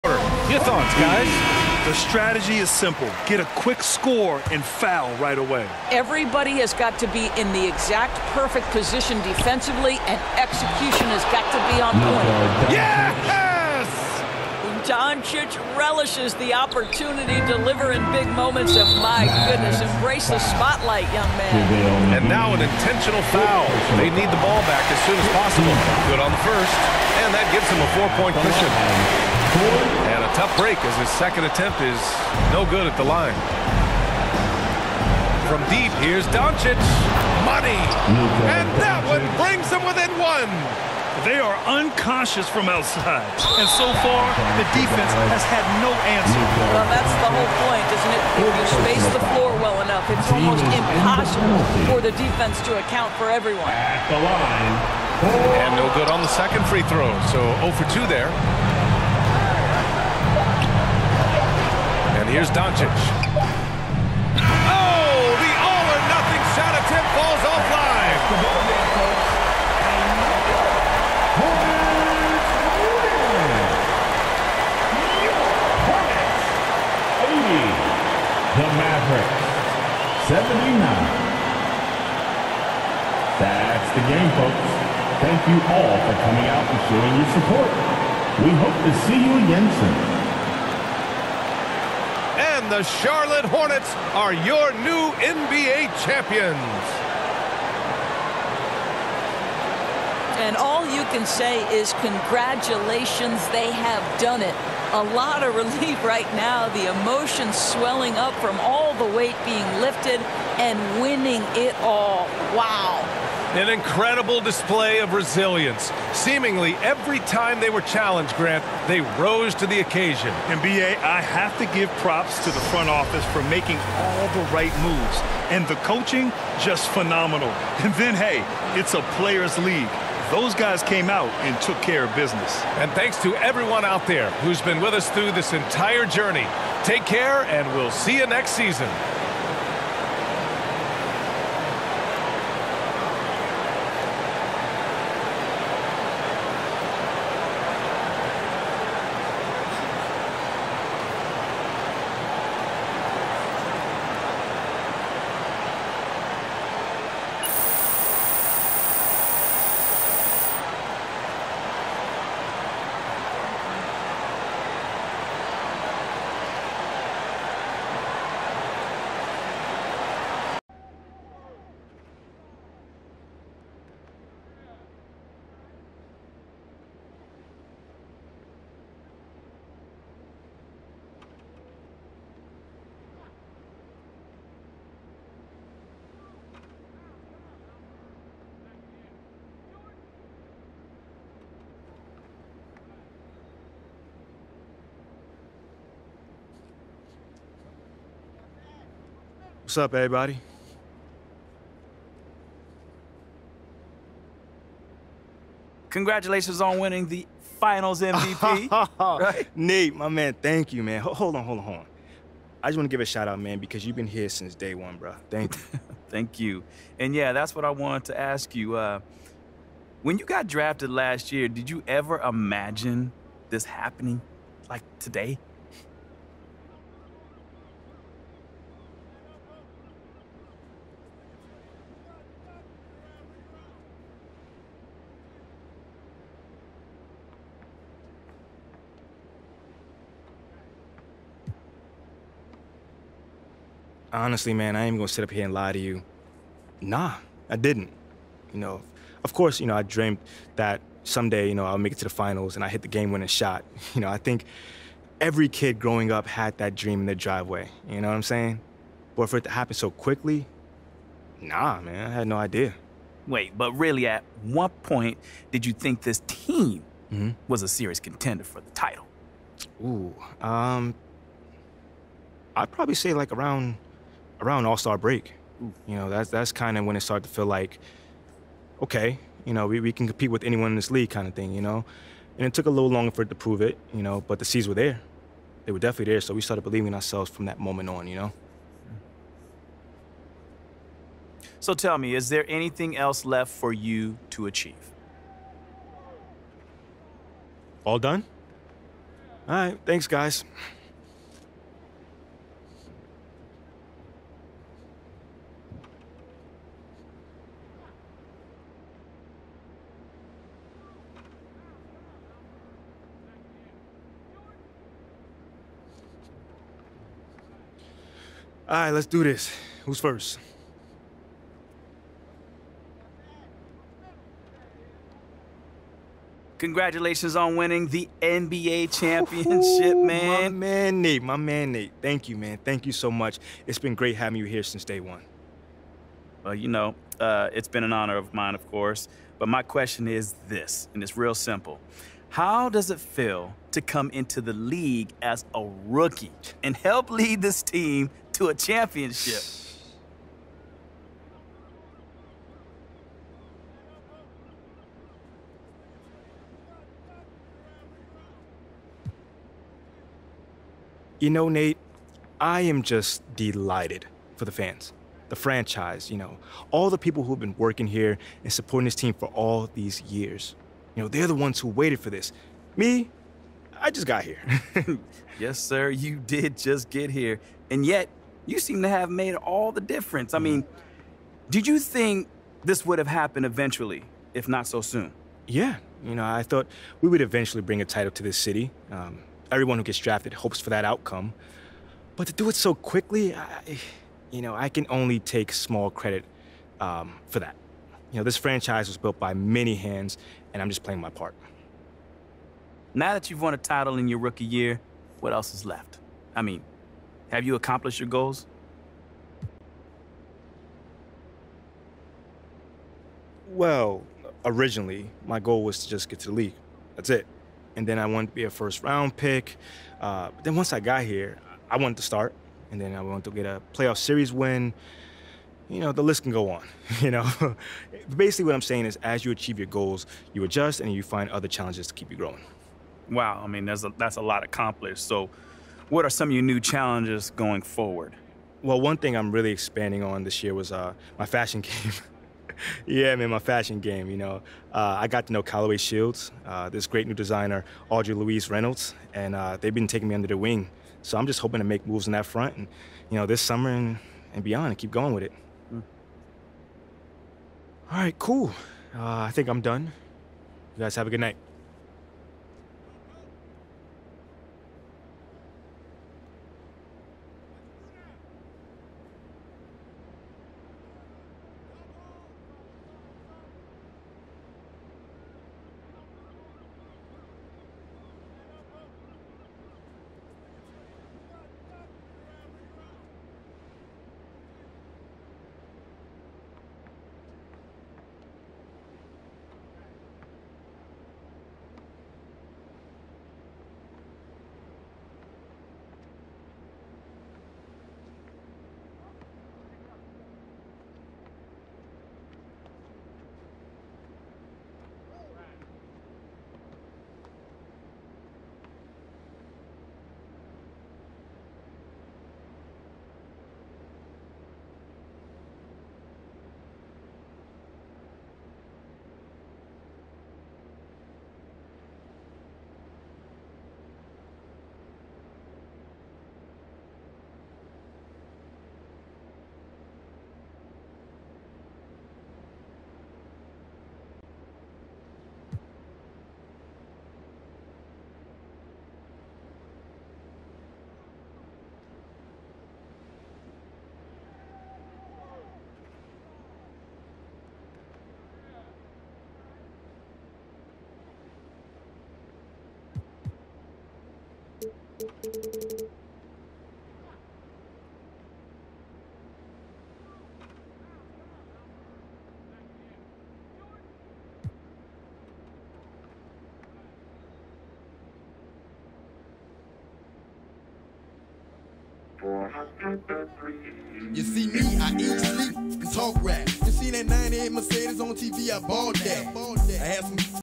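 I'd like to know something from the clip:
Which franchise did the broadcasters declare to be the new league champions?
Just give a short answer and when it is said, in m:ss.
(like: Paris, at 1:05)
Charlotte Hornets, at 1:32.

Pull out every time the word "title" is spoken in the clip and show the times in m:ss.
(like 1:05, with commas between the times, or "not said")
4:28, 6:27, 6:43.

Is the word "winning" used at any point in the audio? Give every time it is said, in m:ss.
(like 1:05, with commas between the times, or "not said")
1:51, 3:26, 4:13, 5:27.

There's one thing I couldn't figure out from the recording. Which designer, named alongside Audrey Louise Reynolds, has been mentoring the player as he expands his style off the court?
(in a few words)
Callaway Shields.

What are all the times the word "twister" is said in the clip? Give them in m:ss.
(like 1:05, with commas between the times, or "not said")
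not said.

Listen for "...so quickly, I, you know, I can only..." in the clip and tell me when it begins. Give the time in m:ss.
6:32.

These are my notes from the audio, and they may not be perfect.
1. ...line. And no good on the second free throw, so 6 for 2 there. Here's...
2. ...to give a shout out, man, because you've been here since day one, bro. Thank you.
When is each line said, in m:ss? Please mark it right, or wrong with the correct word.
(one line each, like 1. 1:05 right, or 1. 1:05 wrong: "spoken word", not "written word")
1. 0:54 wrong: "0", not "6"
2. 3:32 right.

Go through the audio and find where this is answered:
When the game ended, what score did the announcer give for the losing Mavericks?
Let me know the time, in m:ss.
1:20.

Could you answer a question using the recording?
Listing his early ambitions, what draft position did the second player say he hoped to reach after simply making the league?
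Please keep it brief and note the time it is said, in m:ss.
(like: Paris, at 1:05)
first round pick, at 6:58.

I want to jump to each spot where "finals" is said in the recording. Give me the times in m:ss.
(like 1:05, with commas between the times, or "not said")
3:27, 4:12.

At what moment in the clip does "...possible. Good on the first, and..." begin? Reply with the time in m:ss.
0:25.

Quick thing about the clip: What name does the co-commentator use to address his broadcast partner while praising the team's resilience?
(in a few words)
Grant.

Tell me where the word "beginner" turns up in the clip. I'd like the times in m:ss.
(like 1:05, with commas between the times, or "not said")
not said.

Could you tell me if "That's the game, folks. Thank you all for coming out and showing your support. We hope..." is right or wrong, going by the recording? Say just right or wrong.
right.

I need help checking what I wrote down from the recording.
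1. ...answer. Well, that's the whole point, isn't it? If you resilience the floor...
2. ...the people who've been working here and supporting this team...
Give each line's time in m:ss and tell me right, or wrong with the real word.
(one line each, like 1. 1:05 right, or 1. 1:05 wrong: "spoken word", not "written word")
1. 0:46 wrong: "space", not "resilience"
2. 6:06 right.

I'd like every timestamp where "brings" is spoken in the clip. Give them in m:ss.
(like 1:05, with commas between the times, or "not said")
0:39, 6:27.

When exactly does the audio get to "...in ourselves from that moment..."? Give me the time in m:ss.
4:46.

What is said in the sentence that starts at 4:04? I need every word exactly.
honestly, man, I ain't even gonna sit up here and lie to you.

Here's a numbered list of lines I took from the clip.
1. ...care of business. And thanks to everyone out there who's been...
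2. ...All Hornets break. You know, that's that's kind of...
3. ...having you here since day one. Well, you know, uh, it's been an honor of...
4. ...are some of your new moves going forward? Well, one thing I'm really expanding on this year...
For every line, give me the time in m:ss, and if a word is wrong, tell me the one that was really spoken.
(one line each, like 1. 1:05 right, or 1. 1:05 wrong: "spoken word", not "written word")
1. 2:11 right
2. 4:34 wrong: "Star", not "Hornets"
3. 5:34 right
4. 7:16 wrong: "challenges", not "moves".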